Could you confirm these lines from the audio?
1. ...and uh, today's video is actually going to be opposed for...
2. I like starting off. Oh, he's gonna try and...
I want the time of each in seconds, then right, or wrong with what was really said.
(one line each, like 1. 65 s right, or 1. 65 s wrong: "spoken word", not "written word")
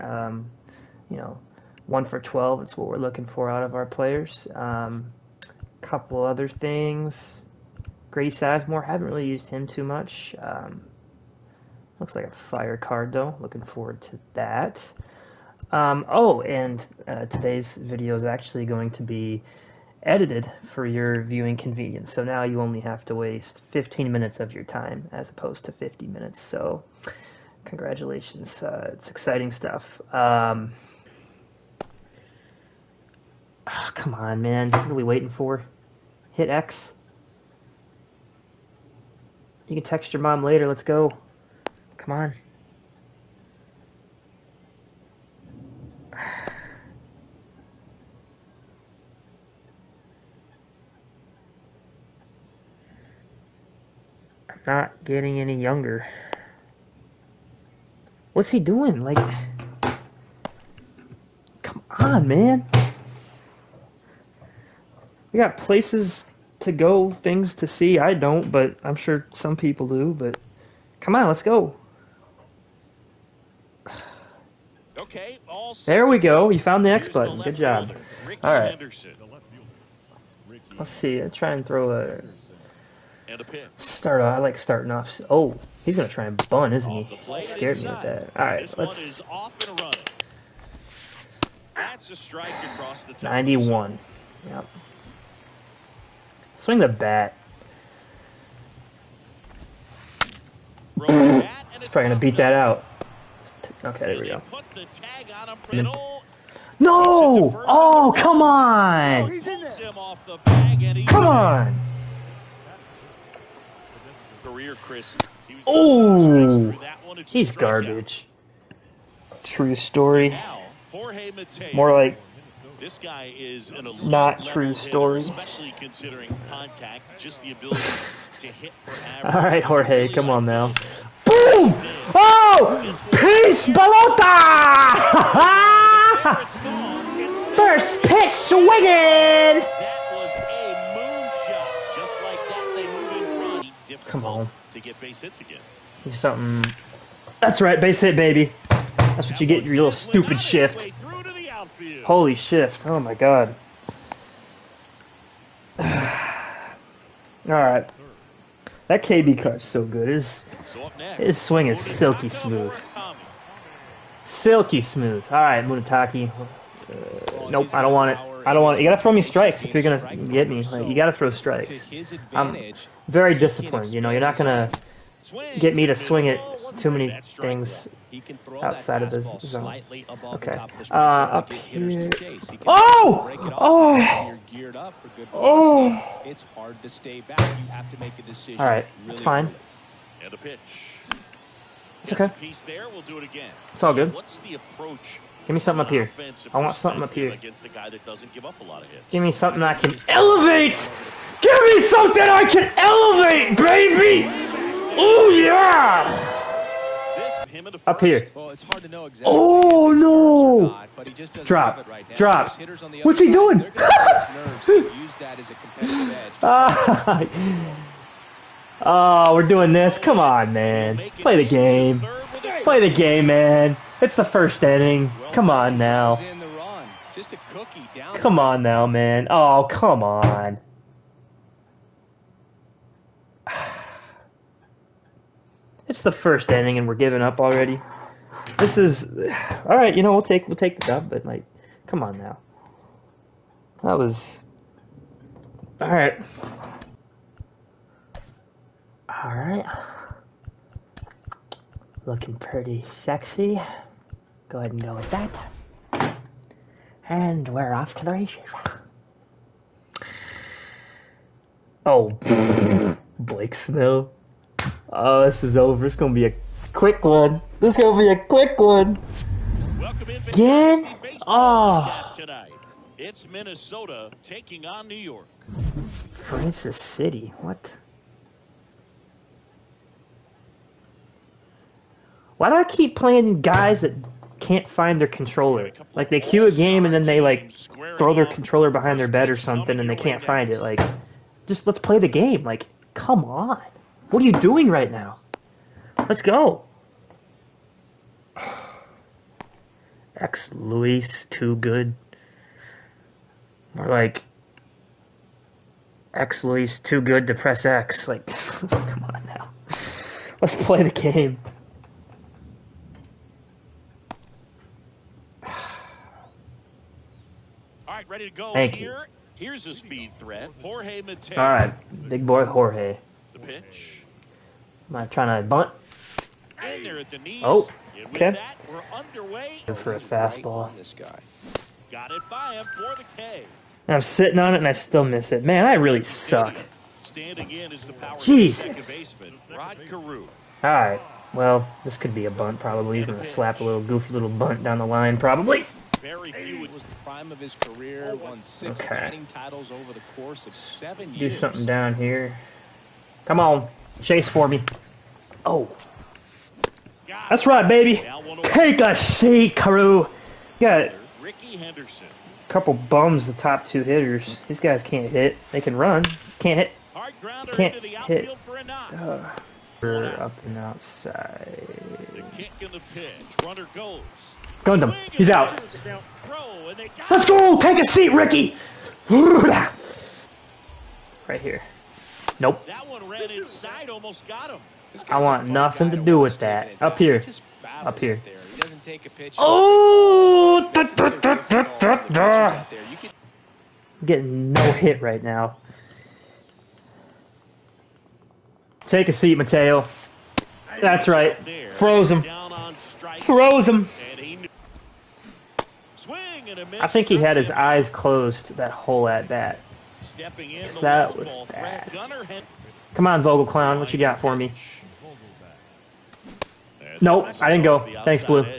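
1. 16 s wrong: "edited", not "opposed"
2. 84 s right.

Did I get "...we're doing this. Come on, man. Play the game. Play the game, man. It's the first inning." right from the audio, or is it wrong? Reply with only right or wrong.
right.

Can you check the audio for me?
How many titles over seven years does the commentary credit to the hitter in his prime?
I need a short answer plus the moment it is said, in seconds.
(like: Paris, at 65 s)
6, at 348 s.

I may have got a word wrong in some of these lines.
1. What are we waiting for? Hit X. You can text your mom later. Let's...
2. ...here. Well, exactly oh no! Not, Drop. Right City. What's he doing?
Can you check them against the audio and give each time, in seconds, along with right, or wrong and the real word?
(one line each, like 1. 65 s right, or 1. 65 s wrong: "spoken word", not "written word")
1. 34 s right
2. 208 s wrong: "Drop", not "City".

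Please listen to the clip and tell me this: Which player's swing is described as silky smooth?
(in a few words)
KB.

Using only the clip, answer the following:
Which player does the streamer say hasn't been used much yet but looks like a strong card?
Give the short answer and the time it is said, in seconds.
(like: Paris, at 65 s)
Grady Sizemore, at 8 s.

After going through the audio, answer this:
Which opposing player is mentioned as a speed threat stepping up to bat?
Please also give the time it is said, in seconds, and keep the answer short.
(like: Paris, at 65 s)
Jorge Mateo, at 320 s.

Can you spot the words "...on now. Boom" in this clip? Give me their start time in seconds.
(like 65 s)
130 s.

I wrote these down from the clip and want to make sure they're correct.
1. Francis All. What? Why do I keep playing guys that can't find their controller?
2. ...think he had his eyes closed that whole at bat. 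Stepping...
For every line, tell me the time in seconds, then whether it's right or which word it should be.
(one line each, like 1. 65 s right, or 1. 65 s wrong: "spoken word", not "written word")
1. 275 s wrong: "City", not "All"
2. 406 s right.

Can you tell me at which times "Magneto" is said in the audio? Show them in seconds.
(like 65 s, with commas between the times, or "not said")
not said.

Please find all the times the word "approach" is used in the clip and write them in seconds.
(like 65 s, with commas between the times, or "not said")
194 s.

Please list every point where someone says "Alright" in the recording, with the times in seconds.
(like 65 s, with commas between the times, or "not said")
155 s, 340 s.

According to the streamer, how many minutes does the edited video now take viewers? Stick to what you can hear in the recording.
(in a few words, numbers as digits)
15.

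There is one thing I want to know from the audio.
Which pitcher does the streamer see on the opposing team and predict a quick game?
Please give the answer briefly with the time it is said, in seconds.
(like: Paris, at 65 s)
Blake Snell, at 263 s.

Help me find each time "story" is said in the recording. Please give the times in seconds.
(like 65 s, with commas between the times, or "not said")
119 s, 124 s.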